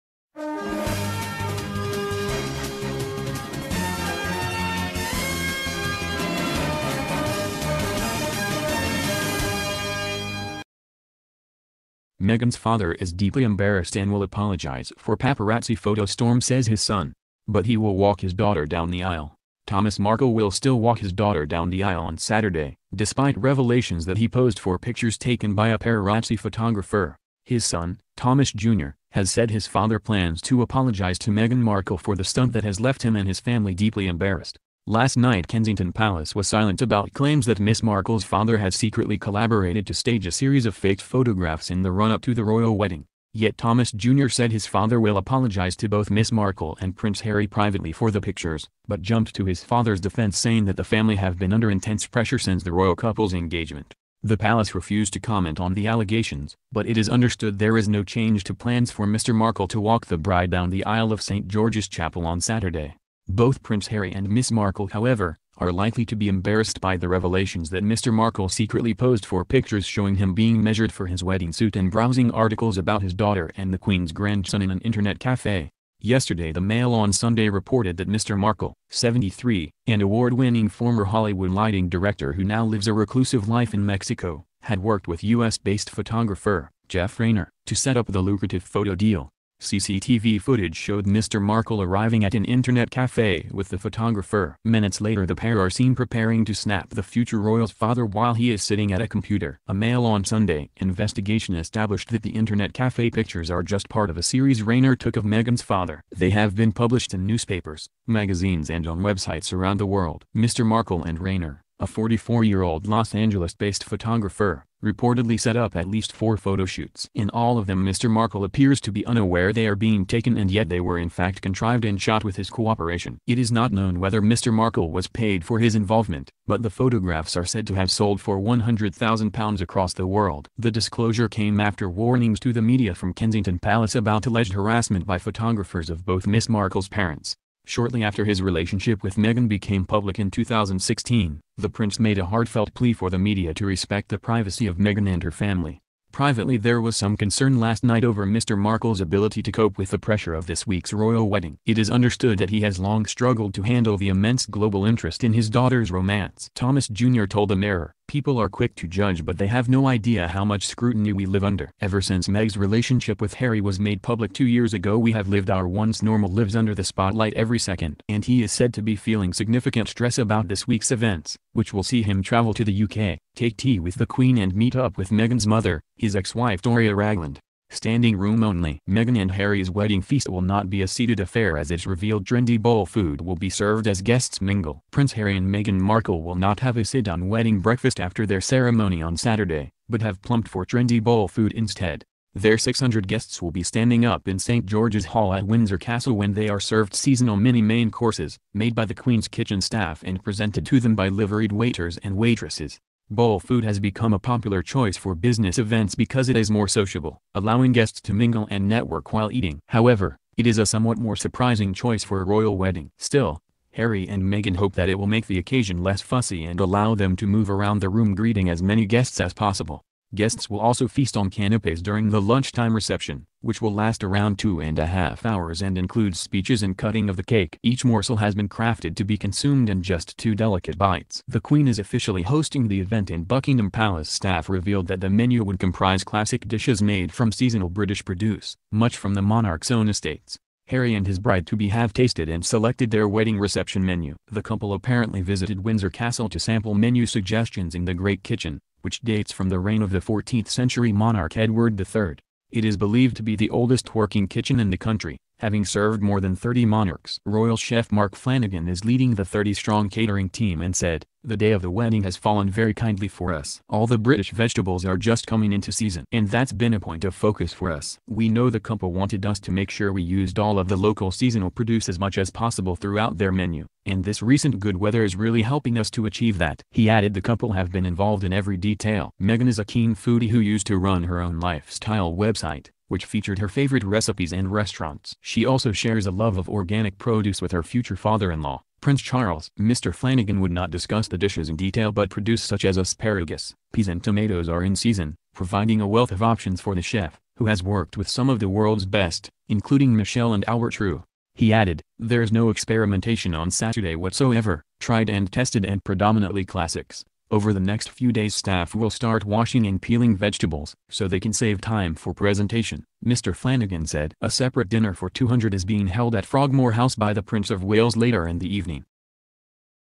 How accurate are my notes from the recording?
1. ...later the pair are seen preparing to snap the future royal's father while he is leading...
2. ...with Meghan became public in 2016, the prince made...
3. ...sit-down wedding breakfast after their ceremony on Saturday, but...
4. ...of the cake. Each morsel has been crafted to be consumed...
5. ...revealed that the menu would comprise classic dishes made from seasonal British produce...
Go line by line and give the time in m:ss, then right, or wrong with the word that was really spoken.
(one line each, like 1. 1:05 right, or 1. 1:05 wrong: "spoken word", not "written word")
1. 1:34 wrong: "sitting", not "leading"
2. 2:19 right
3. 3:06 right
4. 3:47 right
5. 3:54 right.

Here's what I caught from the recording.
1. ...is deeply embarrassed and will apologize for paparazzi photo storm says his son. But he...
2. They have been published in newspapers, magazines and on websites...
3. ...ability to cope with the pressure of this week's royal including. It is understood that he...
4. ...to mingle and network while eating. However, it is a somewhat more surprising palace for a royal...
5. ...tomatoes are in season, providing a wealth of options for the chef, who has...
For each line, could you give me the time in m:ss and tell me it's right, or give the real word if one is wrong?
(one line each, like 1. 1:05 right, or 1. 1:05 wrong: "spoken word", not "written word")
1. 0:12 right
2. 1:46 right
3. 2:28 wrong: "wedding", not "including"
4. 3:27 wrong: "choice", not "palace"
5. 4:54 right.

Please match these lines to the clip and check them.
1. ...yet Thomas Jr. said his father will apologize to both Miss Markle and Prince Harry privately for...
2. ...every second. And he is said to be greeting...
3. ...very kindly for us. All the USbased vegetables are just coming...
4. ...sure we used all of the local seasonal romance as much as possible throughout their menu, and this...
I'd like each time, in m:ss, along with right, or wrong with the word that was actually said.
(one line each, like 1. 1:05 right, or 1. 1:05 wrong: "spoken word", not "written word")
1. 0:43 right
2. 2:47 wrong: "feeling", not "greeting"
3. 4:22 wrong: "British", not "USbased"
4. 4:29 wrong: "produce", not "romance".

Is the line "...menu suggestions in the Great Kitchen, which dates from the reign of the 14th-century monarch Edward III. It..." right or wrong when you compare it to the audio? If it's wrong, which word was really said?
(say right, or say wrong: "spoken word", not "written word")
right.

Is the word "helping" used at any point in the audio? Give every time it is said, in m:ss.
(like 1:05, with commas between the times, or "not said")
4:35.